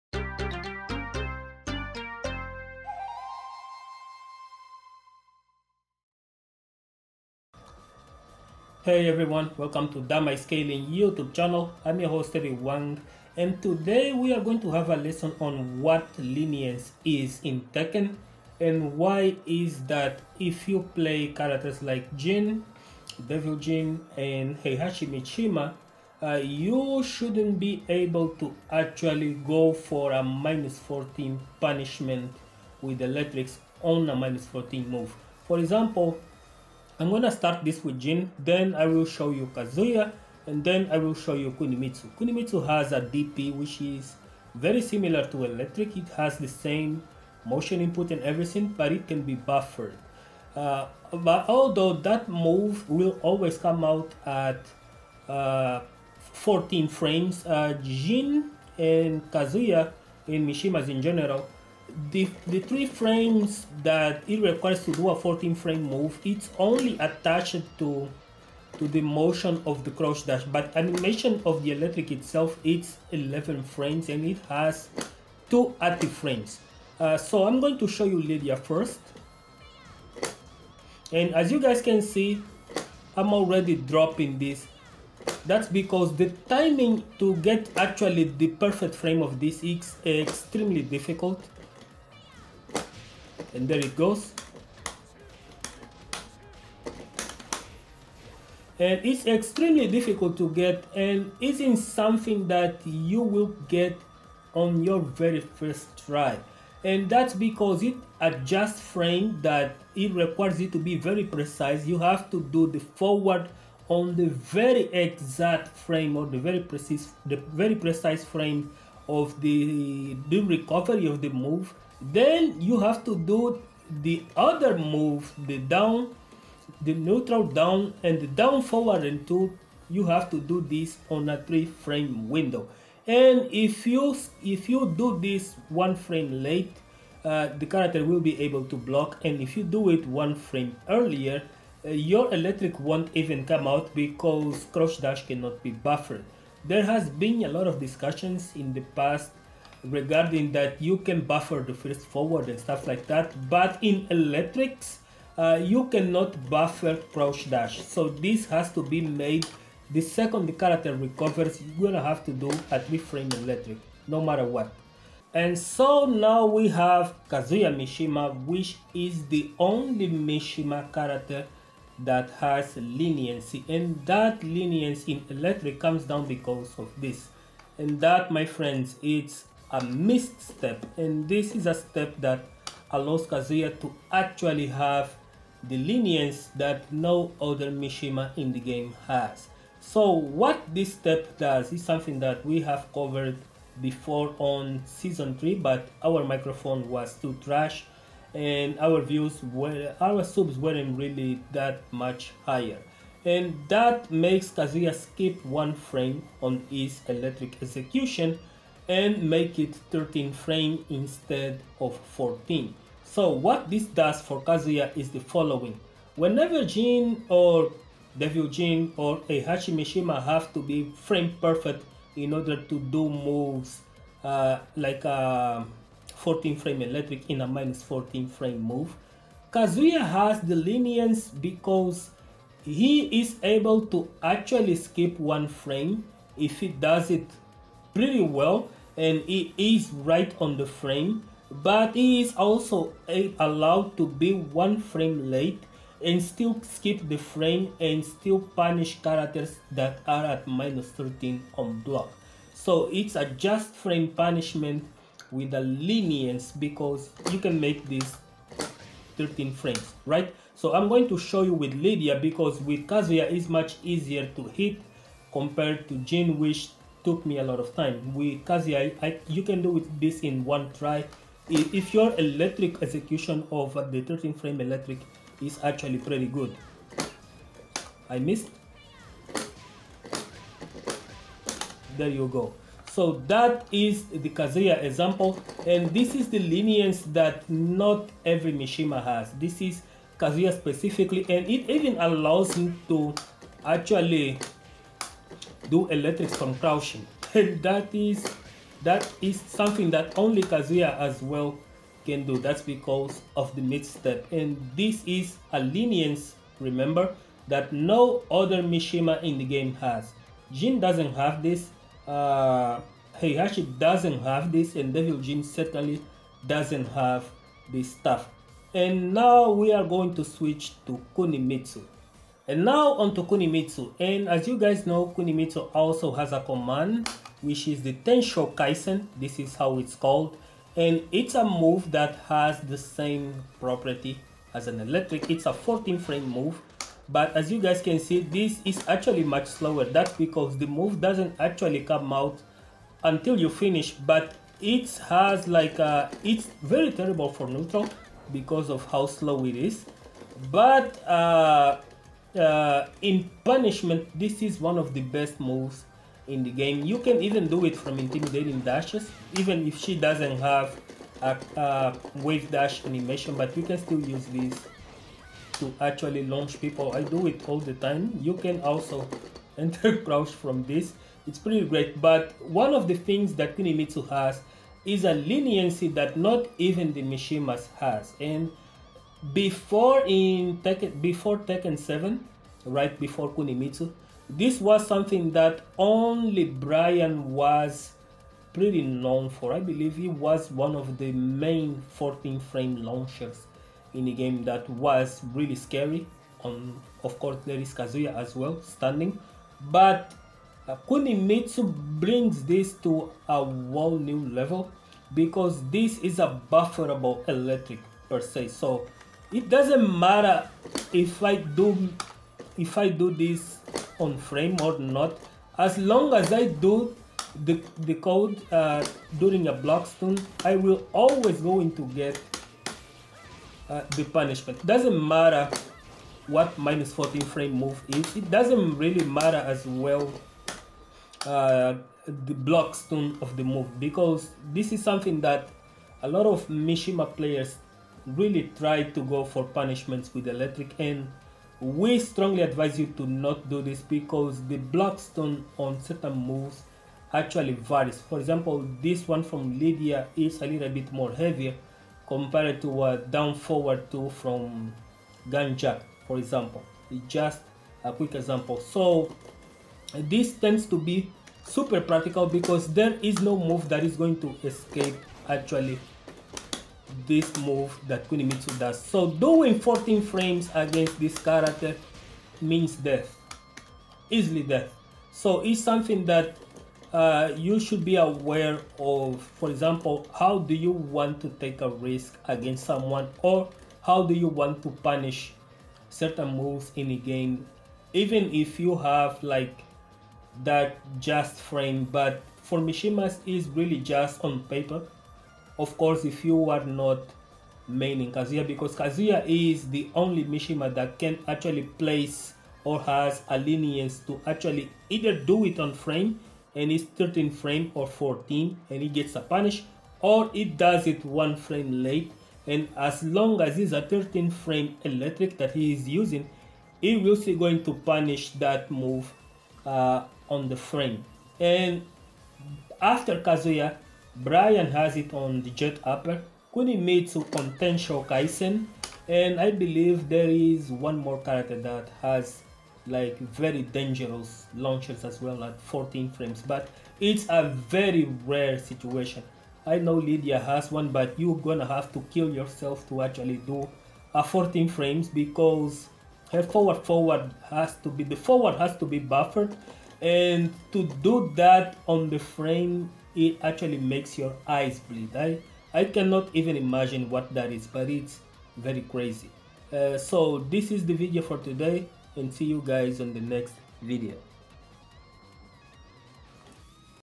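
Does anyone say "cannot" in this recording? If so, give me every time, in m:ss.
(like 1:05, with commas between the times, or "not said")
2:25, 2:35, 9:15.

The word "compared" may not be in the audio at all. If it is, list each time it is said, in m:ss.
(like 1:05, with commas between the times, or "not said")
4:25, 7:32.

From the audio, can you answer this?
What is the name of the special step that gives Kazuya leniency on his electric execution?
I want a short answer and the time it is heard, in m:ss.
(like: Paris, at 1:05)
mist step, at 2:59.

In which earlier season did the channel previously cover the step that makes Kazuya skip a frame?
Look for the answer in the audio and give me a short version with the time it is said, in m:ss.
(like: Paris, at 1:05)
season 3, at 3:14.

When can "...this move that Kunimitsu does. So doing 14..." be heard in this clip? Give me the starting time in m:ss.
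7:47.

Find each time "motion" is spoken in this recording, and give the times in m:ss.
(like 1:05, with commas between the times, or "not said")
0:47, 1:09.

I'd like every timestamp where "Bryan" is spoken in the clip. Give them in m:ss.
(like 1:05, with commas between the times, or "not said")
6:26, 8:44.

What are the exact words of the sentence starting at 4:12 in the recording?
So it's a just frame punishment with a lenience because you can make this 13 frames, right?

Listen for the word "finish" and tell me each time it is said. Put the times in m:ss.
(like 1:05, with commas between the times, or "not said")
5:43.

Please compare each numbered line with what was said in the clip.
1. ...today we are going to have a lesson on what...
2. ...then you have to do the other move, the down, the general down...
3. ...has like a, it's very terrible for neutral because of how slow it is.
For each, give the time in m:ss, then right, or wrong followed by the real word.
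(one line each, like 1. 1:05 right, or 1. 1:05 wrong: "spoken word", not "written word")
1. 0:13 right
2. 2:02 wrong: "neutral", not "general"
3. 5:45 right.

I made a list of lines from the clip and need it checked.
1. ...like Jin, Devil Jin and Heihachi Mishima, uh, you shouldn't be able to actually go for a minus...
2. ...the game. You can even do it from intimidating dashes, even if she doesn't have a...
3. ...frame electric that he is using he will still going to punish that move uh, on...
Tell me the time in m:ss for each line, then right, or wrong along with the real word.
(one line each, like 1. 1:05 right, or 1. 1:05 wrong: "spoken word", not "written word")
1. 0:21 right
2. 5:56 right
3. 8:34 right.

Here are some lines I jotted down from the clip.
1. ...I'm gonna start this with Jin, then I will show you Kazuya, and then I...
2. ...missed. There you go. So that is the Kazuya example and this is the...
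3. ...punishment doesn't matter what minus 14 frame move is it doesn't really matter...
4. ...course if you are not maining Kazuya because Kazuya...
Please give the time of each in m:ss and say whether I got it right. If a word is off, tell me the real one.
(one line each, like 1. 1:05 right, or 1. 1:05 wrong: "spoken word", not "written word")
1. 0:37 right
2. 4:38 right
3. 7:04 right
4. 8:15 right.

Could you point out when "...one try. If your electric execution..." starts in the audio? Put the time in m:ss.
4:30.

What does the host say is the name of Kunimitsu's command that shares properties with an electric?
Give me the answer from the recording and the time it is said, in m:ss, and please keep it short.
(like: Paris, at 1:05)
Tensho Kaisen, at 5:27.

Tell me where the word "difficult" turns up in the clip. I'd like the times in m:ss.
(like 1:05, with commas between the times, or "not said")
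1:30, 1:39.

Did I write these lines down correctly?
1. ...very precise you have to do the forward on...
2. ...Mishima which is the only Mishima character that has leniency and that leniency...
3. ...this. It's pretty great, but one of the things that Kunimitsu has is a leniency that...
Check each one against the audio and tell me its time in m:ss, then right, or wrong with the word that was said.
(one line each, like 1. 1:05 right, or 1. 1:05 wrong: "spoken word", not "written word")
1. 1:50 right
2. 2:47 right
3. 6:10 right.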